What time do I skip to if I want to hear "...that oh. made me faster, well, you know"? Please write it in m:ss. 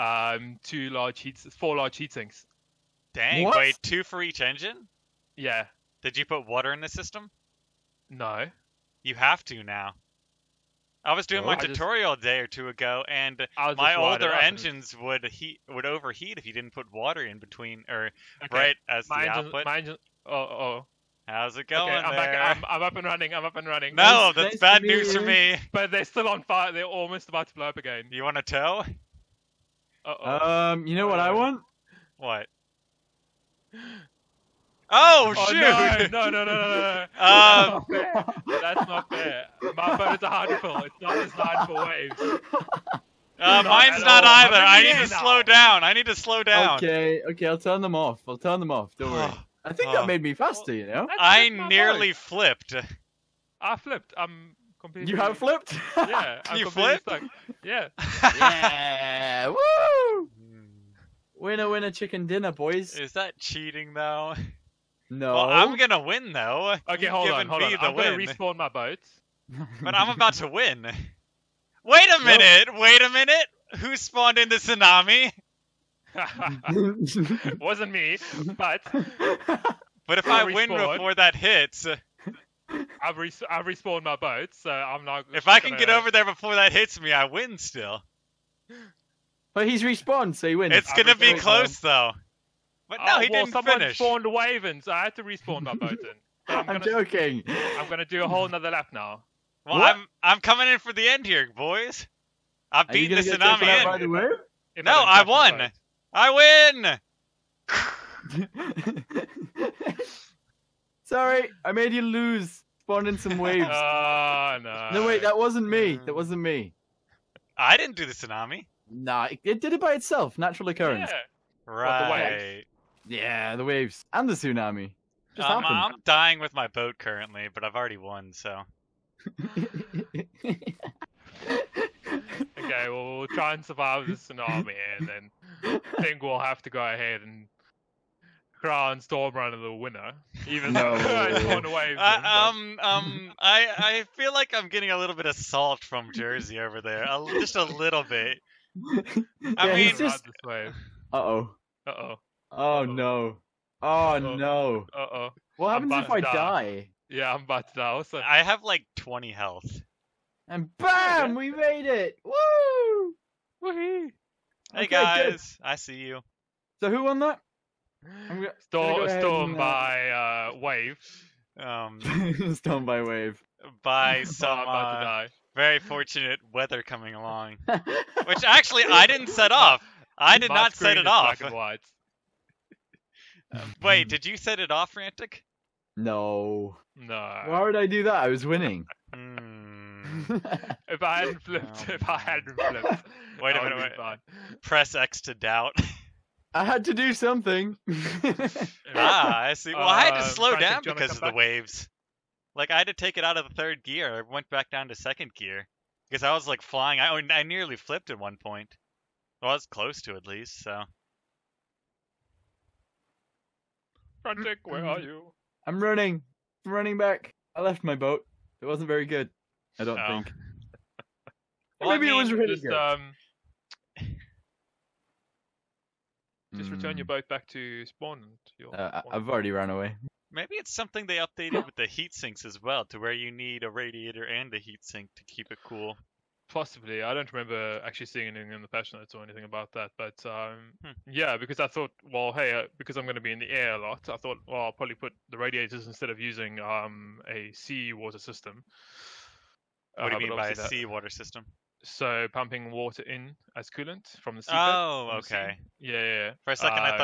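0:49.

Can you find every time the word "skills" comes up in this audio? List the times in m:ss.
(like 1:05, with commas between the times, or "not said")
not said.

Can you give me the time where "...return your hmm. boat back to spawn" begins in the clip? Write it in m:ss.
3:46.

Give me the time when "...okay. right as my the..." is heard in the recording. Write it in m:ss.
0:18.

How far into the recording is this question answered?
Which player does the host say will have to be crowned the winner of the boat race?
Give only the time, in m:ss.
2:19.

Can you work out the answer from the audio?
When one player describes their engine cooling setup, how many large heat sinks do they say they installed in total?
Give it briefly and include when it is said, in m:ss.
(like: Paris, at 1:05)
4, at 0:01.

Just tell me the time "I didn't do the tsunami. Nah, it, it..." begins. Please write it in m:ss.
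1:57.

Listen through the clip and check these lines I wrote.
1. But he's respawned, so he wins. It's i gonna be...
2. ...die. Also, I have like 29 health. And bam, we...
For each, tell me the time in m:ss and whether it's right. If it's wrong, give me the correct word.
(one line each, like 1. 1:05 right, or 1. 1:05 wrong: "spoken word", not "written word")
1. 1:29 right
2. 2:37 wrong: "20", not "29".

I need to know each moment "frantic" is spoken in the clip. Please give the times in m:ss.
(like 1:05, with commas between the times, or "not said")
3:04, 3:20, 3:34.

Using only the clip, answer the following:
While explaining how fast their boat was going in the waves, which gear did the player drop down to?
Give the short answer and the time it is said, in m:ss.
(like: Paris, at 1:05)
second gear, at 3:24.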